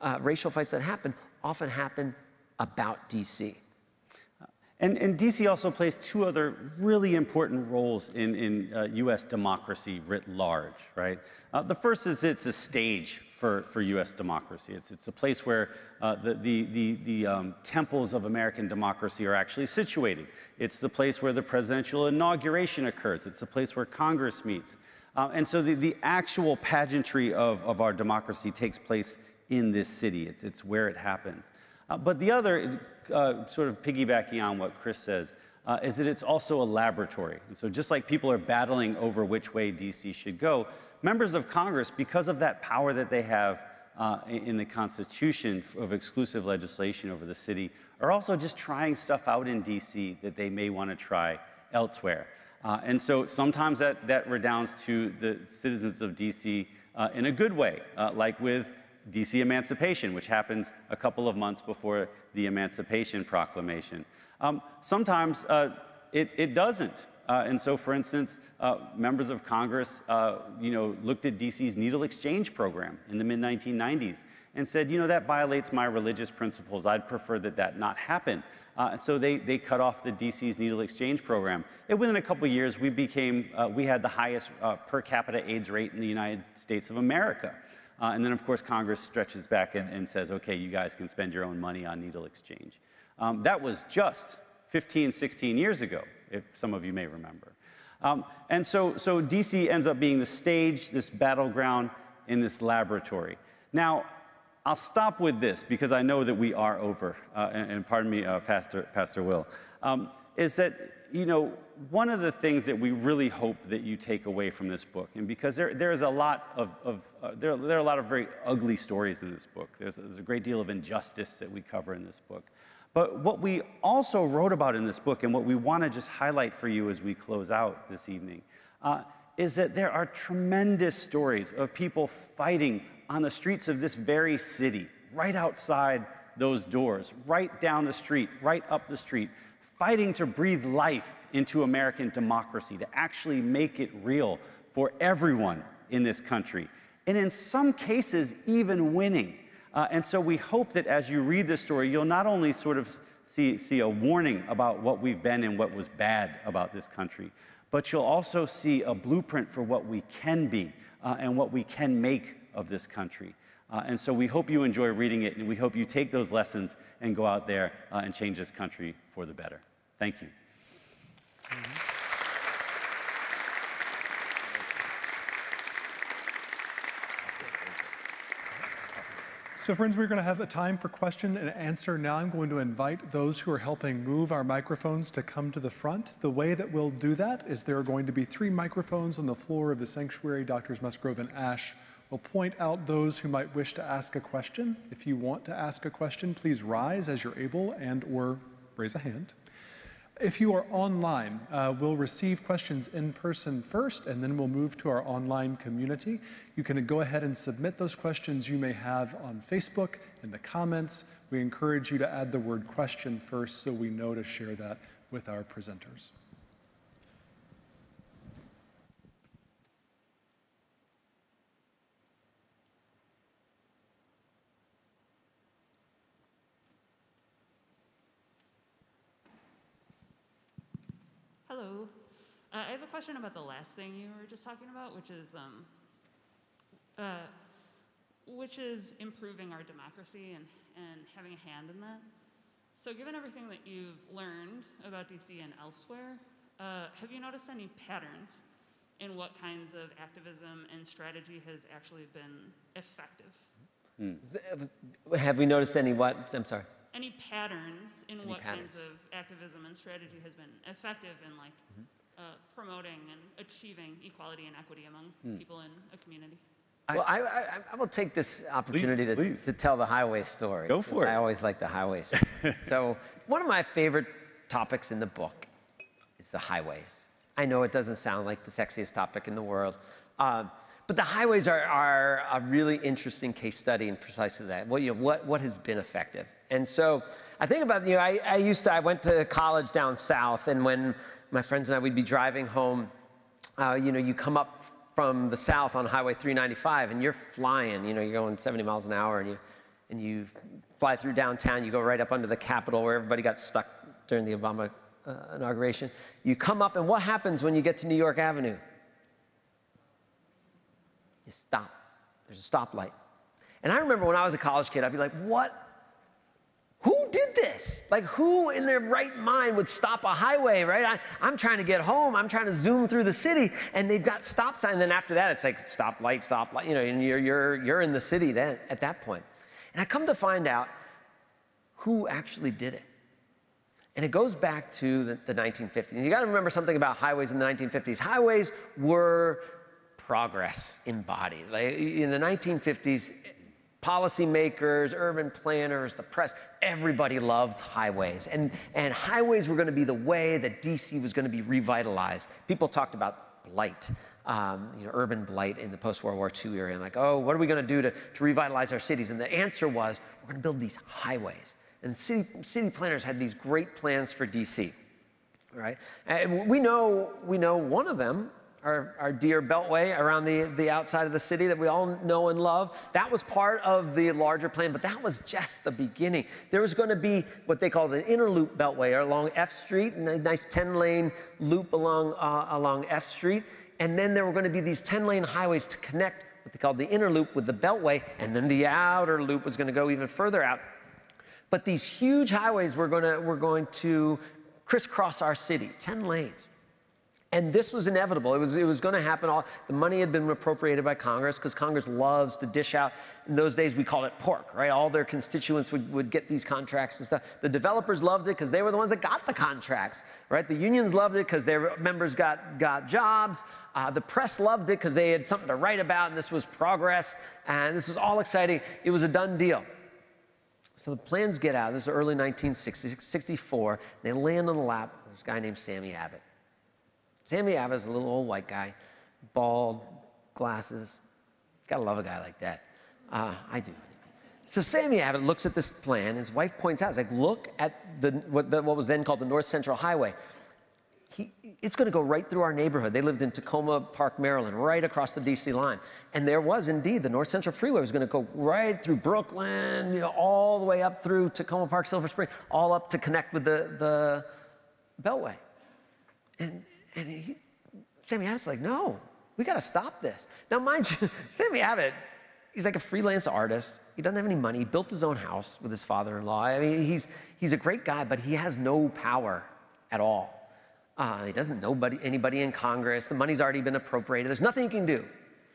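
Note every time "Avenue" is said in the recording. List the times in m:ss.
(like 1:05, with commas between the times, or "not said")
5:08.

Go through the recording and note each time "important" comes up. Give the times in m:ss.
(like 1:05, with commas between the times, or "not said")
0:07.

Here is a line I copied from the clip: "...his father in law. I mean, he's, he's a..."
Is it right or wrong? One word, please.
right.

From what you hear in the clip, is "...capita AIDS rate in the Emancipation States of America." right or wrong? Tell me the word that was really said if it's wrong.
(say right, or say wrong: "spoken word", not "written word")
wrong: "United", not "Emancipation".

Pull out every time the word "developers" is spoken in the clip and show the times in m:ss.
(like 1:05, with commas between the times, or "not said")
6:47.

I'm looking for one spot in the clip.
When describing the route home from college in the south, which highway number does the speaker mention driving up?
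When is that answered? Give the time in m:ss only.
4:56.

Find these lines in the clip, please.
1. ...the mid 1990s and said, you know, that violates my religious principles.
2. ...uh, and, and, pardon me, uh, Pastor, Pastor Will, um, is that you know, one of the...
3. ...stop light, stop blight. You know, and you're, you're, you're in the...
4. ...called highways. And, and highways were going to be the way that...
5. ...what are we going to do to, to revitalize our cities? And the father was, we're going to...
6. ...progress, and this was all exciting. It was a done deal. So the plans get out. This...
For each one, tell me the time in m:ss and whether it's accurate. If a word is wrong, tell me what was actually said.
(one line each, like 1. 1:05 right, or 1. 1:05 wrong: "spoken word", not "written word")
1. 1:13 right
2. 1:47 right
3. 5:25 wrong: "light", not "blight"
4. 5:47 wrong: "loved", not "called"
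5. 5:57 wrong: "answer", not "father"
6. 6:56 right.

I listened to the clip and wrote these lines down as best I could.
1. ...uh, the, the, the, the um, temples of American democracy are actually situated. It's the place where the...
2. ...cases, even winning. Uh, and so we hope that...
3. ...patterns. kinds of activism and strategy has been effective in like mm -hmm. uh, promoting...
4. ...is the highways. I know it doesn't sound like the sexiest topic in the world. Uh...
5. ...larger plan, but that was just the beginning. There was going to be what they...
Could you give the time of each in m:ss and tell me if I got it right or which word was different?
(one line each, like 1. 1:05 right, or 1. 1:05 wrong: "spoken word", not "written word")
1. 0:16 right
2. 2:27 right
3. 4:18 right
4. 4:36 right
5. 6:14 right.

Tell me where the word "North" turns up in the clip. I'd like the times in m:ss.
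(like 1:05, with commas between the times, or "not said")
7:19, 7:27.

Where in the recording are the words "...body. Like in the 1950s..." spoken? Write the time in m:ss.
5:41.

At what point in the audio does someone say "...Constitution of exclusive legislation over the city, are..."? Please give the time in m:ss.
0:44.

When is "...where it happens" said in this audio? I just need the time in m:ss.
0:30.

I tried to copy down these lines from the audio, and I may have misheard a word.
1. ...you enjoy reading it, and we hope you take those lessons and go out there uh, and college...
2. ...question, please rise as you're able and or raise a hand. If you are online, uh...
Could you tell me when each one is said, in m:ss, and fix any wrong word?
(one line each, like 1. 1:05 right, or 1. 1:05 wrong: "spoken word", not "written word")
1. 2:44 wrong: "change", not "college"
2. 3:15 right.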